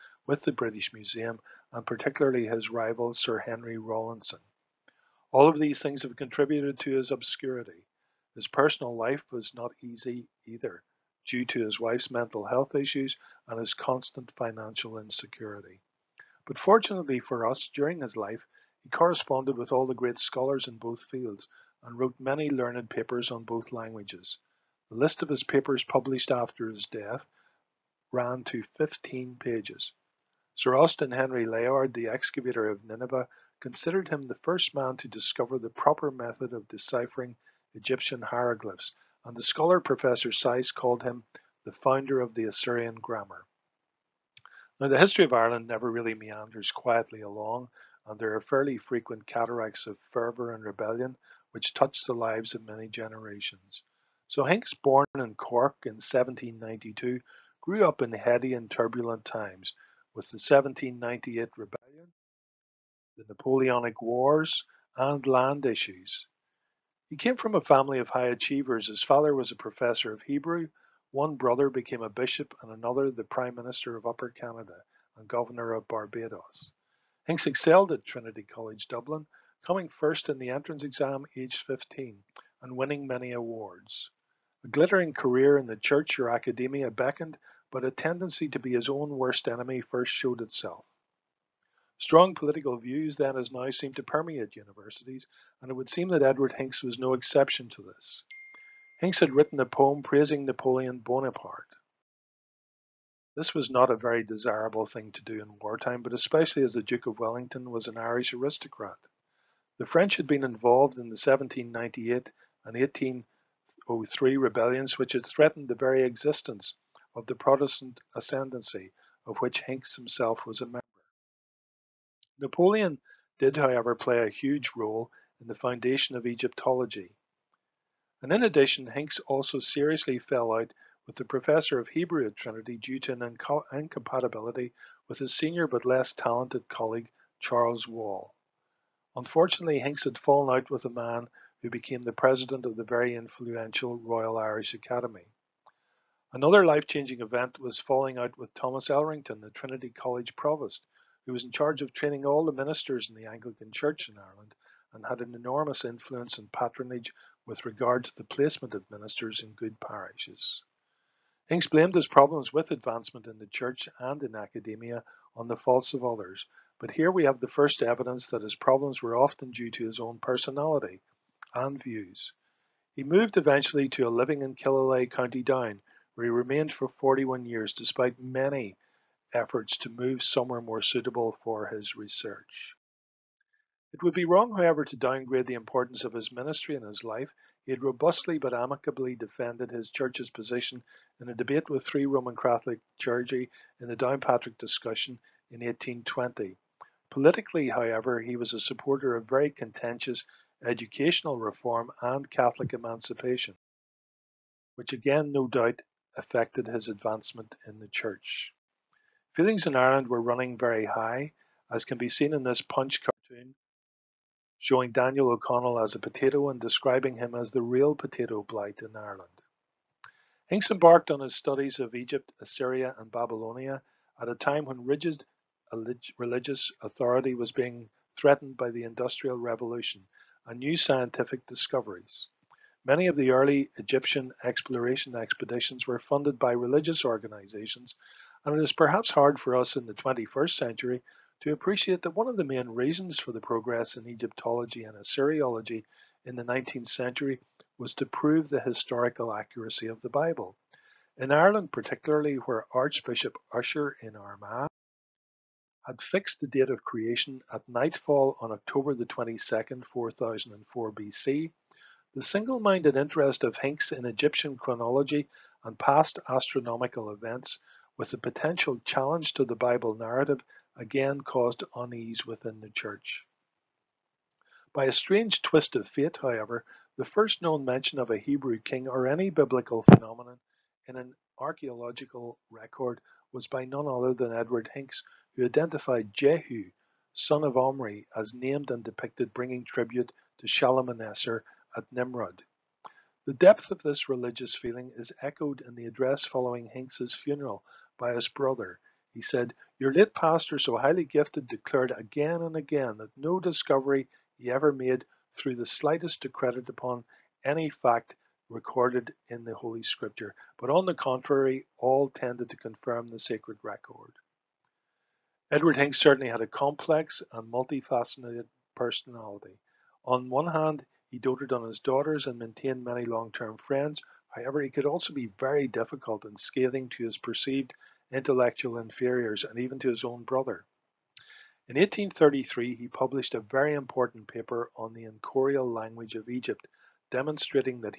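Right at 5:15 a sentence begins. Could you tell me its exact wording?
Edward Hincks certainly had a complex and multifaceted personality.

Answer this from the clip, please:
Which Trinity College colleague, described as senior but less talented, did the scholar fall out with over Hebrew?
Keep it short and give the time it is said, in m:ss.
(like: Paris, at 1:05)
Charles Wall, at 2:17.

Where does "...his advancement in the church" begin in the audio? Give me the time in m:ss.
3:26.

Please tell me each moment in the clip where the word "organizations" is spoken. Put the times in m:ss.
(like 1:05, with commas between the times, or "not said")
3:57.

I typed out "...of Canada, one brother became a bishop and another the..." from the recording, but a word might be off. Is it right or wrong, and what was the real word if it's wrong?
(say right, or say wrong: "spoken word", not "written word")
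wrong: "Hebrew", not "Canada".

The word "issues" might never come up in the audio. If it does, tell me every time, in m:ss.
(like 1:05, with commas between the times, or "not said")
0:12, 1:05.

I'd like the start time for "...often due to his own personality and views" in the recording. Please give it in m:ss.
2:49.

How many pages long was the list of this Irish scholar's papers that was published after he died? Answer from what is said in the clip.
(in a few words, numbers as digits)
15.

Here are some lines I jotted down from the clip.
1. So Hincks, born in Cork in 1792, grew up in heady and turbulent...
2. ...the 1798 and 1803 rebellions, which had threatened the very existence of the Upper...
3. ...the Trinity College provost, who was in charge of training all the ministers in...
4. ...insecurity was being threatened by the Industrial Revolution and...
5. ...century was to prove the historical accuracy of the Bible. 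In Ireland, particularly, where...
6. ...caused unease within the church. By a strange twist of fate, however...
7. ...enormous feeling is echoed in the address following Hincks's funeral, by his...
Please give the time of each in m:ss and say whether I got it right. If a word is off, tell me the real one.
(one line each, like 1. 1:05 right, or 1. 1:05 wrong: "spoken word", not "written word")
1. 0:54 right
2. 1:51 wrong: "Protestant", not "Upper"
3. 2:29 right
4. 3:46 wrong: "authority", not "insecurity"
5. 4:06 right
6. 4:31 right
7. 4:54 wrong: "religious", not "enormous".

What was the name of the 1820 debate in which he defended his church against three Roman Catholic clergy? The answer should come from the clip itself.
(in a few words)
Downpatrick discussion.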